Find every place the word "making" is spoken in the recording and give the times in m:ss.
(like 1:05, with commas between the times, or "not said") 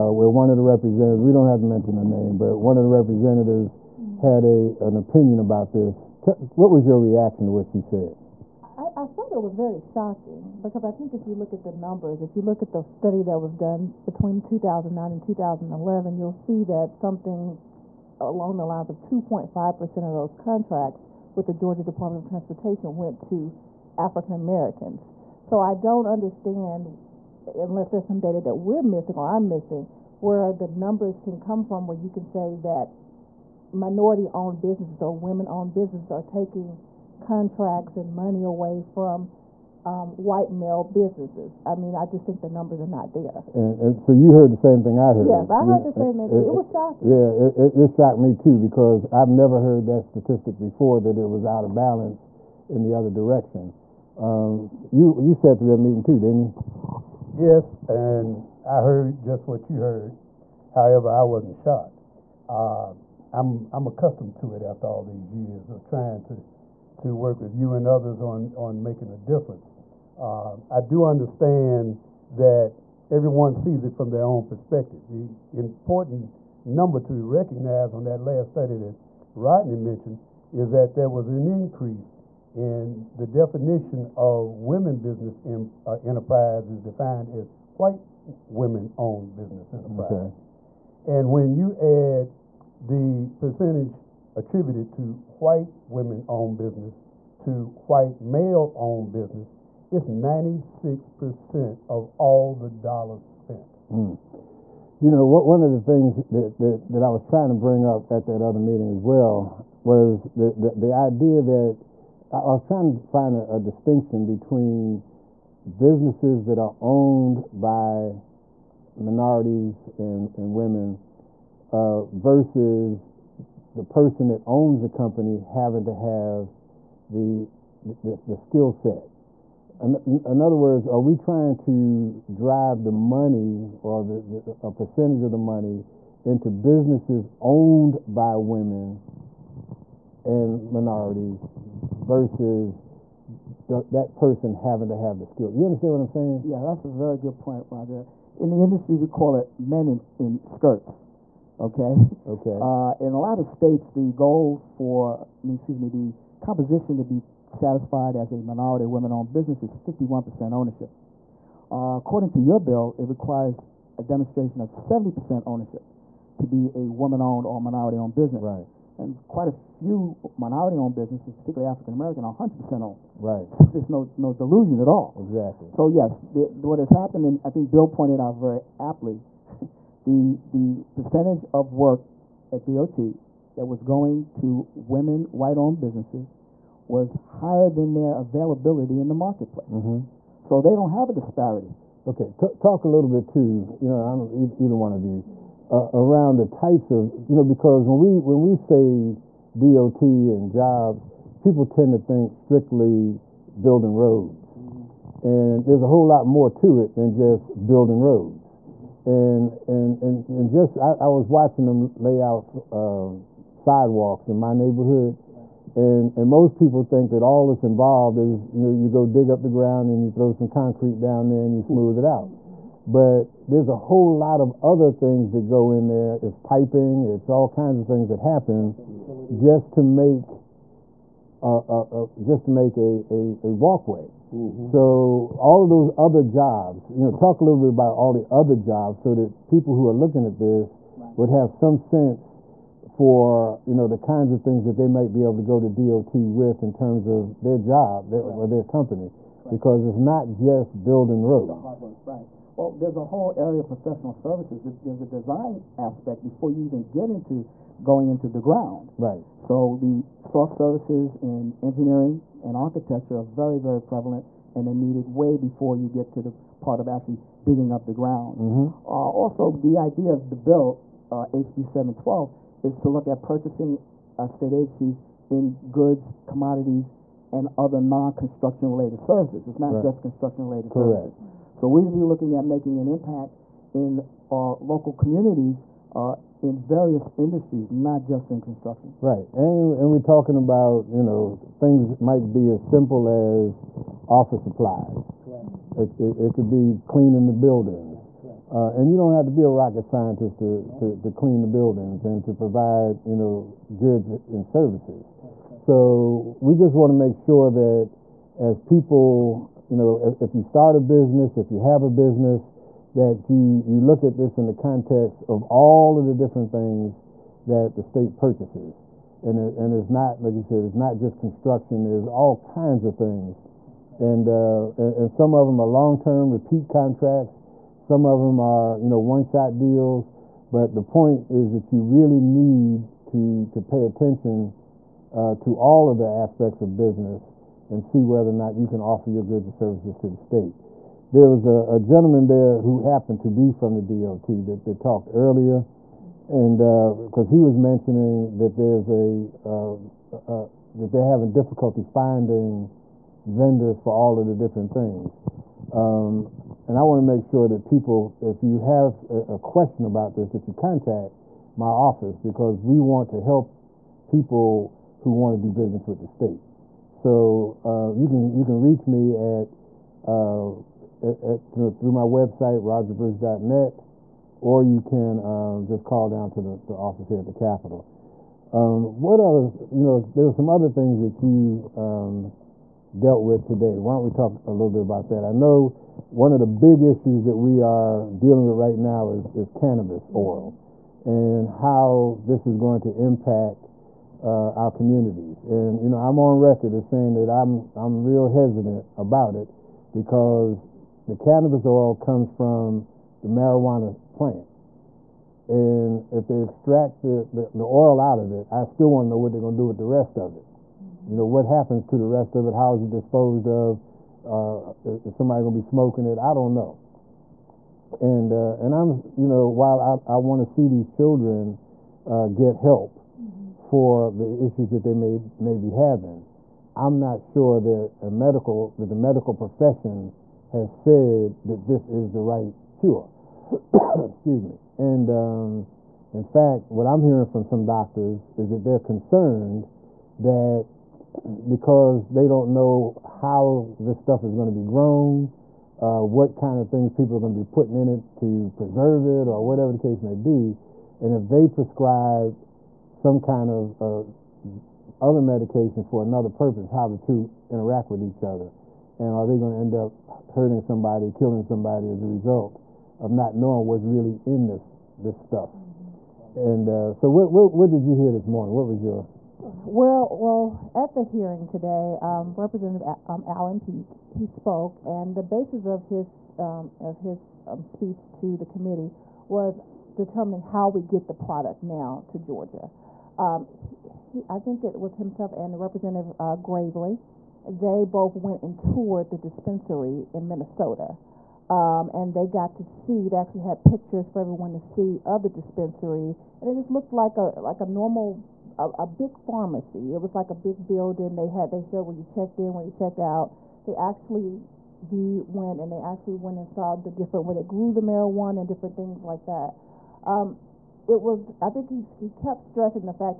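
1:08, 4:42.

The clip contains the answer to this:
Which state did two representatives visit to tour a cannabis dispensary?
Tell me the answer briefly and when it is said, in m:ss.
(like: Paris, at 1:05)
Minnesota, at 8:10.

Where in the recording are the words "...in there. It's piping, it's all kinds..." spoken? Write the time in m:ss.
3:45.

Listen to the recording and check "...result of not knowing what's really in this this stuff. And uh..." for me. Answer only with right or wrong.
right.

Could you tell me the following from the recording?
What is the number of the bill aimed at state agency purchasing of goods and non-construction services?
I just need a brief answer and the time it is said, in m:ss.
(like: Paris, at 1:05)
HB 712, at 4:31.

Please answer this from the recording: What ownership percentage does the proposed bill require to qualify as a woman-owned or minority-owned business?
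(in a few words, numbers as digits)
70%.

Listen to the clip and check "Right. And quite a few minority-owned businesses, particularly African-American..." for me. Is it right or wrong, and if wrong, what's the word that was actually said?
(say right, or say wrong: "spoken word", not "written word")
right.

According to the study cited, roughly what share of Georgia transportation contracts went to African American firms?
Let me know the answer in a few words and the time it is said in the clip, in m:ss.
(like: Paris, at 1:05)
2.5%, at 0:18.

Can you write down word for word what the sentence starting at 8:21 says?
They had they showed where you checked in, where you checked out.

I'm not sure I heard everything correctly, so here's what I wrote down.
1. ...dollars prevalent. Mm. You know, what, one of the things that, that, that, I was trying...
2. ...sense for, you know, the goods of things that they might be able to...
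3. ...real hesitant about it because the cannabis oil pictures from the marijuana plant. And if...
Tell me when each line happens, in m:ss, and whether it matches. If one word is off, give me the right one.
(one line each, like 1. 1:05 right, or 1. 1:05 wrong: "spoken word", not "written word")
1. 1:42 wrong: "spent", not "prevalent"
2. 4:01 wrong: "kinds", not "goods"
3. 6:38 wrong: "comes", not "pictures".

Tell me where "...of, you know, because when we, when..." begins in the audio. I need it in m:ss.
3:16.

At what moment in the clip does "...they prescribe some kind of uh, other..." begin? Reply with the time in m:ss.
7:31.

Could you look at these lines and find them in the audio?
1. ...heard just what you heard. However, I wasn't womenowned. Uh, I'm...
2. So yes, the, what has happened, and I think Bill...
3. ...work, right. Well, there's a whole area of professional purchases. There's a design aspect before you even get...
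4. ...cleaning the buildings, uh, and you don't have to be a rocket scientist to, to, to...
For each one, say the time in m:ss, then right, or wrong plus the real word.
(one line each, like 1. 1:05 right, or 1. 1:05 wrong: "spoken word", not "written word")
1. 0:58 wrong: "shocked", not "womenowned"
2. 2:55 right
3. 4:11 wrong: "services", not "purchases"
4. 4:56 right.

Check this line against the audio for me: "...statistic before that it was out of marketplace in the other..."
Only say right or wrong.
wrong.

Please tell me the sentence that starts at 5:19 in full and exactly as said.
And, it, and it's not, like you said, it's not just construction, there's all kinds of things.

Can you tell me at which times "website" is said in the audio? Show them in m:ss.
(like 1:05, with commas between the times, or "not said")
6:12.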